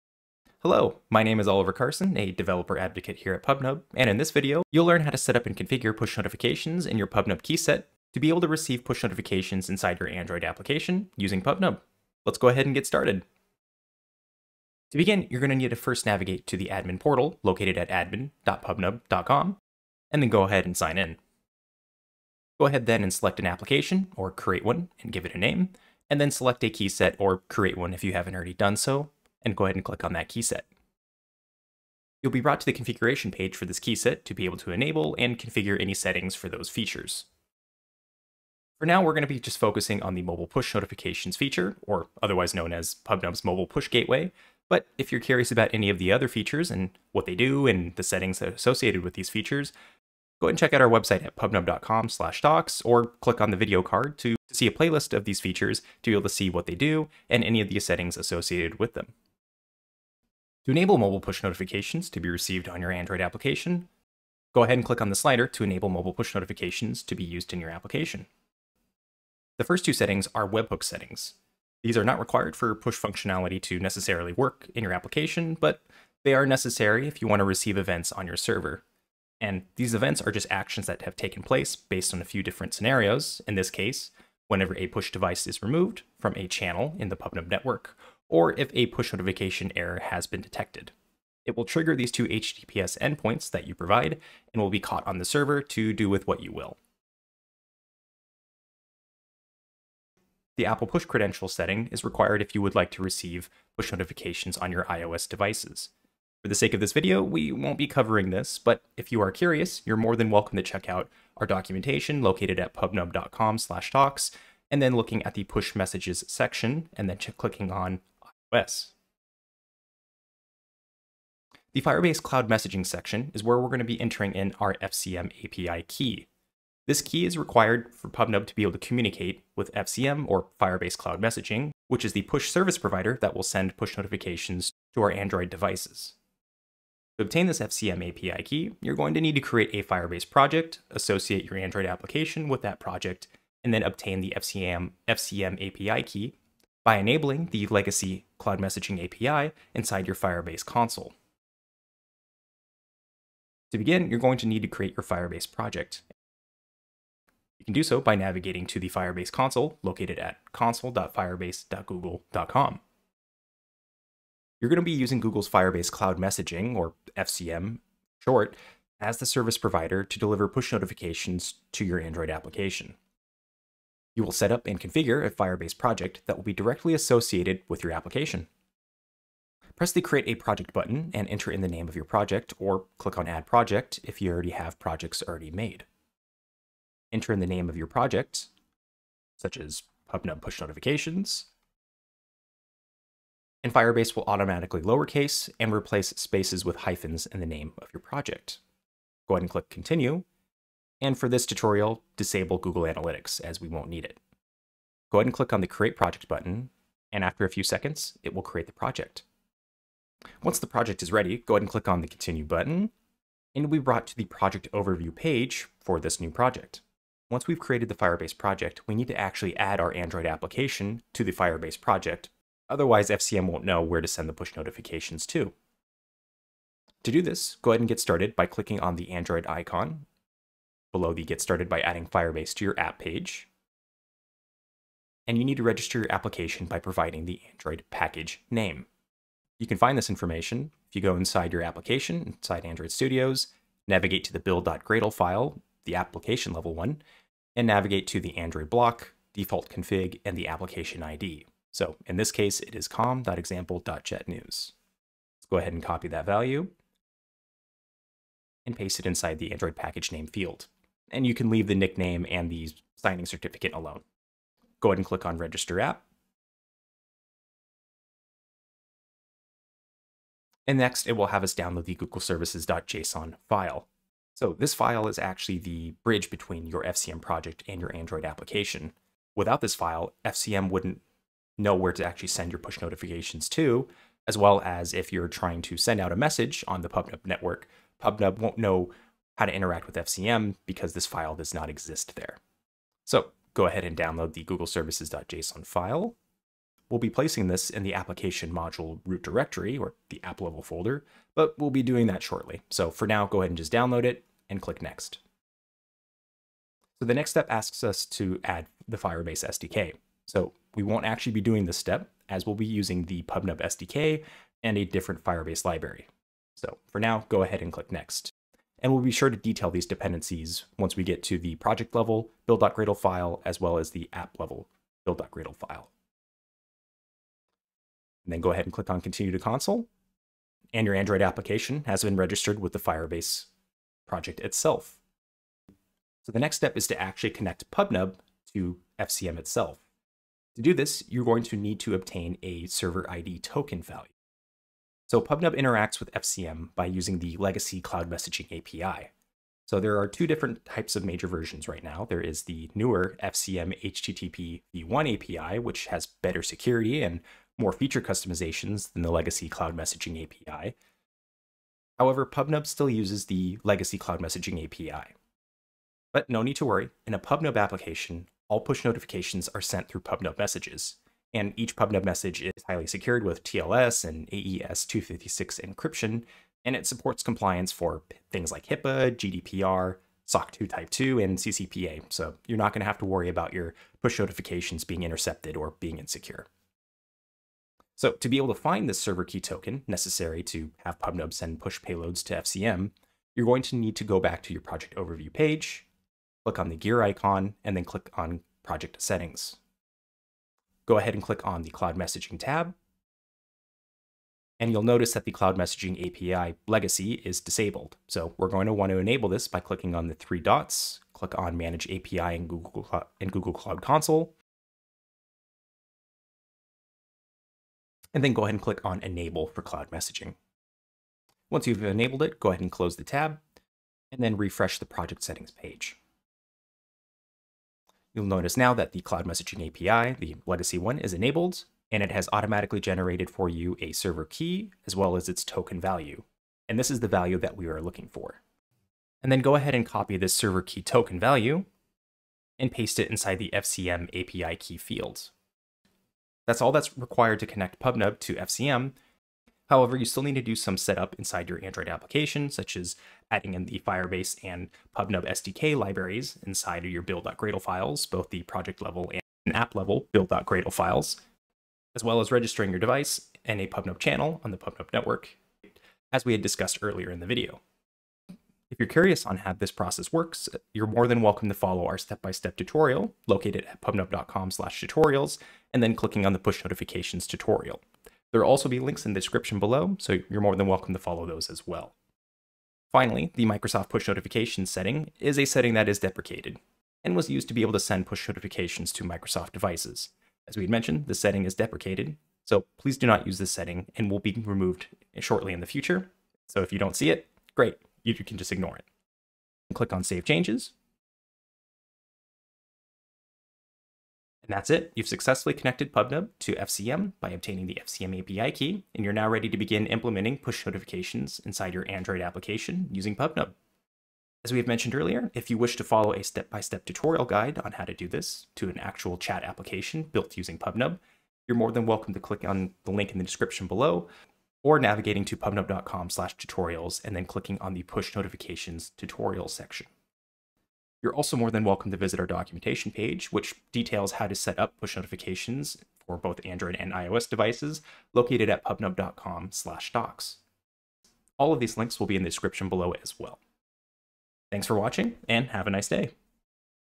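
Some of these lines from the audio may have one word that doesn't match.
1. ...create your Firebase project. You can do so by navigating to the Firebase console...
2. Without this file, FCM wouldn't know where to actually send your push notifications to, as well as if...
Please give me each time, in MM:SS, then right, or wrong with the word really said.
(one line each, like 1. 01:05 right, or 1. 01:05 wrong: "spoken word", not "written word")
1. 02:34 right
2. 04:39 right.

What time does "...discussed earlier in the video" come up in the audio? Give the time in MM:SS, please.
07:46.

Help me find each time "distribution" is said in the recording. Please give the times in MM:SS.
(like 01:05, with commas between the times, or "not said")
not said.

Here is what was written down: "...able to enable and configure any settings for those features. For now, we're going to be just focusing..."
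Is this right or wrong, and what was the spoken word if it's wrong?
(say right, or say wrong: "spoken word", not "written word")
right.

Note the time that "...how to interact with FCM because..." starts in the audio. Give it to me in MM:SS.
04:49.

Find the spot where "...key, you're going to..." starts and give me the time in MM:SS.
02:18.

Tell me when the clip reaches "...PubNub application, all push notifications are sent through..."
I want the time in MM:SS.
06:07.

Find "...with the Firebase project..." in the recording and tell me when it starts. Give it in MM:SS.
05:32.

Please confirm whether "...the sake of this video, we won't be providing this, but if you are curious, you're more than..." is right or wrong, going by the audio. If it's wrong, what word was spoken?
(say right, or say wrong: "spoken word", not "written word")
wrong: "covering", not "providing".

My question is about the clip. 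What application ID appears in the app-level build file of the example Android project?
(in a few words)
com.example.jetnews.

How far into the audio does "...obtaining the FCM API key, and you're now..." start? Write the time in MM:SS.
08:27.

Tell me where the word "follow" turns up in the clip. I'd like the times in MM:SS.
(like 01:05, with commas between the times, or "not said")
07:51, 08:00, 08:35.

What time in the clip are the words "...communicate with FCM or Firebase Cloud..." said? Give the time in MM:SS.
02:08.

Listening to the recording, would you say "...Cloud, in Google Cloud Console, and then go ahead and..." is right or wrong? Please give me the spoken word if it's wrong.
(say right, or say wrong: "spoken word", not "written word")
right.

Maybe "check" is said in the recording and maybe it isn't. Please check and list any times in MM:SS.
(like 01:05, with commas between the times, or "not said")
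00:50, 01:50.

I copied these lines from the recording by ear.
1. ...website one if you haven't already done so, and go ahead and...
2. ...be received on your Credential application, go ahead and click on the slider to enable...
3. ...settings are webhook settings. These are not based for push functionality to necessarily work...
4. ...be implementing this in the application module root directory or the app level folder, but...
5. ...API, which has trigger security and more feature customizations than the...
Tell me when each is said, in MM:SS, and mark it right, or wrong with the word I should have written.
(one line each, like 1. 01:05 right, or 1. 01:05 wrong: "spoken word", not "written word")
1. 00:27 wrong: "create", not "website"
2. 01:02 wrong: "Android", not "Credential"
3. 01:09 wrong: "required", not "based"
4. 04:56 wrong: "placing", not "implementing"
5. 05:55 wrong: "better", not "trigger".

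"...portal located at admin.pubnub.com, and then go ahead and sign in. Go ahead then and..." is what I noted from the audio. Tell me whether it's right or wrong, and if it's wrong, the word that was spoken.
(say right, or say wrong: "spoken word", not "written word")
right.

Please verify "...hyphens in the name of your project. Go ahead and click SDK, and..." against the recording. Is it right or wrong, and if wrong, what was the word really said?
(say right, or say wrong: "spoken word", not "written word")
wrong: "Continue", not "SDK".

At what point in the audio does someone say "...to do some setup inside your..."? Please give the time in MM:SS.
07:30.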